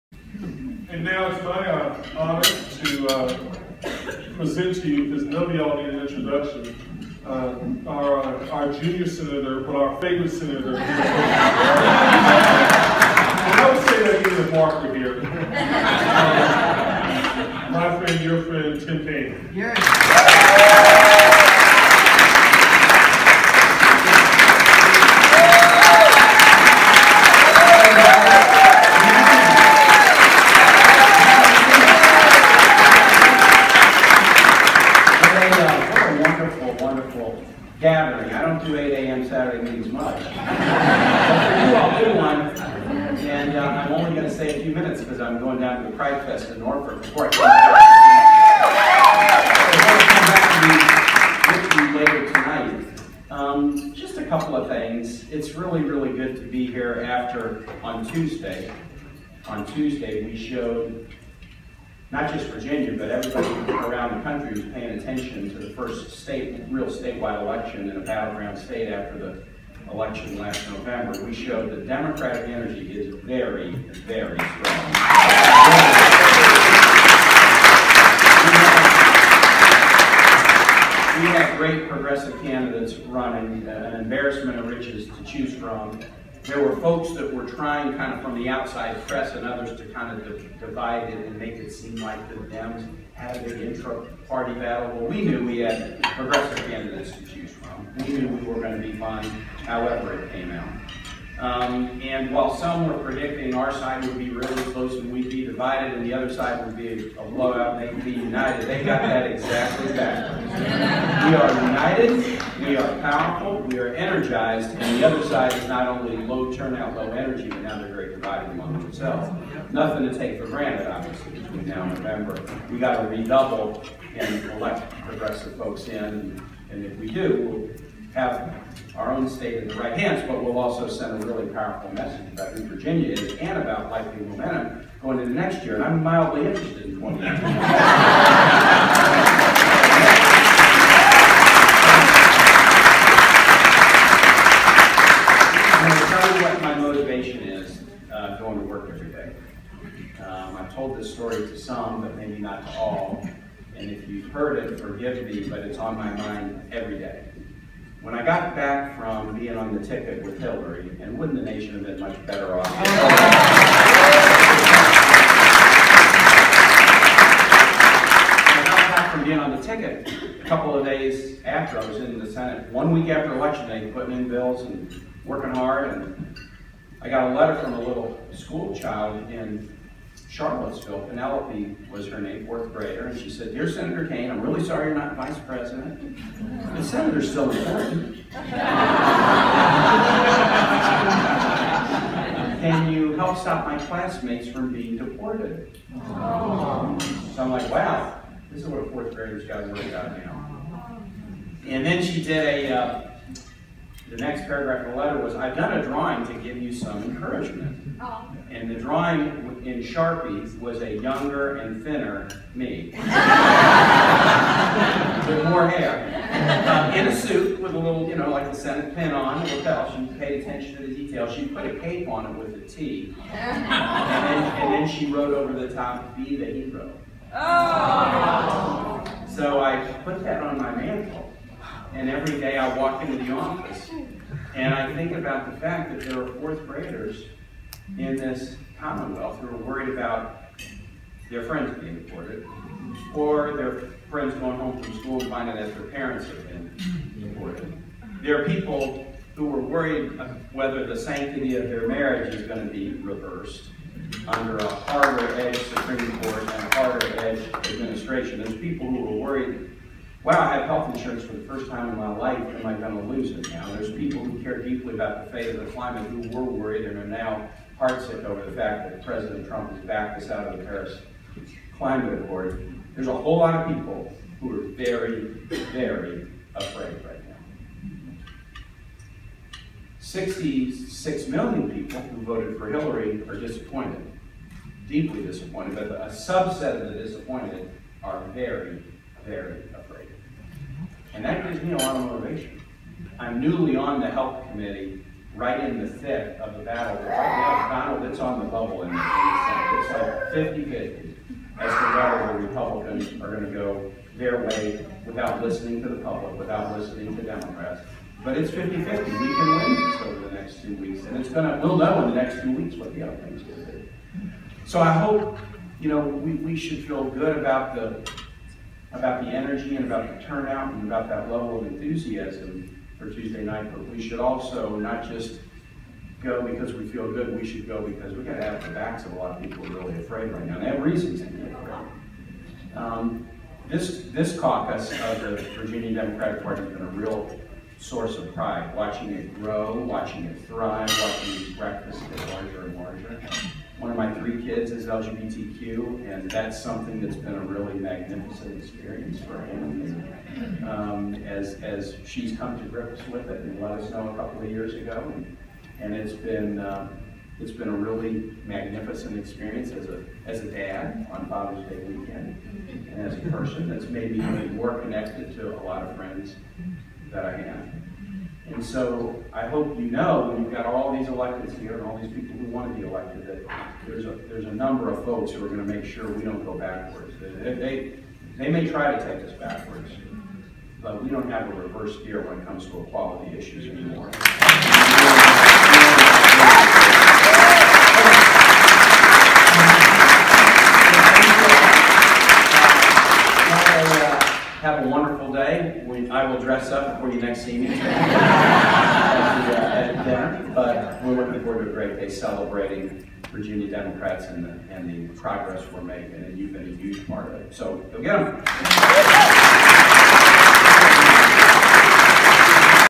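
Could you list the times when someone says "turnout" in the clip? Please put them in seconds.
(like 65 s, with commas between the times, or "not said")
116 s, 320 s.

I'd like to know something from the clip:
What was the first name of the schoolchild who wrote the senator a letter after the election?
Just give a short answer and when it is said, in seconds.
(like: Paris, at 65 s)
Penelope, at 181 s.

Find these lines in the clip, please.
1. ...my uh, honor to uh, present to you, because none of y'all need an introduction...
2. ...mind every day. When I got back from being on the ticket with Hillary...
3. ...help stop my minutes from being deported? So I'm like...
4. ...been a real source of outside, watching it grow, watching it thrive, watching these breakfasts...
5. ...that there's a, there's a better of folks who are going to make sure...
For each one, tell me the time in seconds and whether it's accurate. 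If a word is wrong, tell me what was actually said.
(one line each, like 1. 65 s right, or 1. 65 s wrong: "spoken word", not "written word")
1. 1 s right
2. 156 s right
3. 193 s wrong: "classmates", not "minutes"
4. 336 s wrong: "pride", not "outside"
5. 373 s wrong: "number", not "better".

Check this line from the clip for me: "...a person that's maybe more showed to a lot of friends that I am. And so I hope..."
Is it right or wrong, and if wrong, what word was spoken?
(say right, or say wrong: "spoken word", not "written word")
wrong: "connected", not "showed".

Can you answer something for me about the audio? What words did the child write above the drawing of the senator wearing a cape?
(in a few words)
Be the hero.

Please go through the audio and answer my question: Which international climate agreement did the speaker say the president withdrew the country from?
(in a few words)
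Paris Climate Accord.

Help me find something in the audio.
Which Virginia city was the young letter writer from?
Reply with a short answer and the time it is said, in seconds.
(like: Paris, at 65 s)
Charlottesville, at 180 s.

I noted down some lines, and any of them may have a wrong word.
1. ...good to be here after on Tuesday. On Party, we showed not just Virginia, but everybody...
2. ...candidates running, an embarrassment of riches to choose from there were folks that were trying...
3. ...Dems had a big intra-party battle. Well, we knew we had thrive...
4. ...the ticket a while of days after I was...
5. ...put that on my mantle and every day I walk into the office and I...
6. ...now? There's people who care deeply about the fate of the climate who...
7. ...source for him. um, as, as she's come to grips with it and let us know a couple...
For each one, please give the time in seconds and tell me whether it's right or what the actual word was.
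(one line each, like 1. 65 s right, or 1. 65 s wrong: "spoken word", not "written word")
1. 56 s wrong: "Tuesday", not "Party"
2. 82 s right
3. 92 s wrong: "progressive", not "thrive"
4. 169 s wrong: "couple", not "while"
5. 230 s right
6. 263 s right
7. 348 s wrong: "experience", not "source".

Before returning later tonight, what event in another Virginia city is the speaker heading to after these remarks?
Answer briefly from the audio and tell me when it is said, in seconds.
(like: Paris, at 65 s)
Pride Fest in Norfolk, at 45 s.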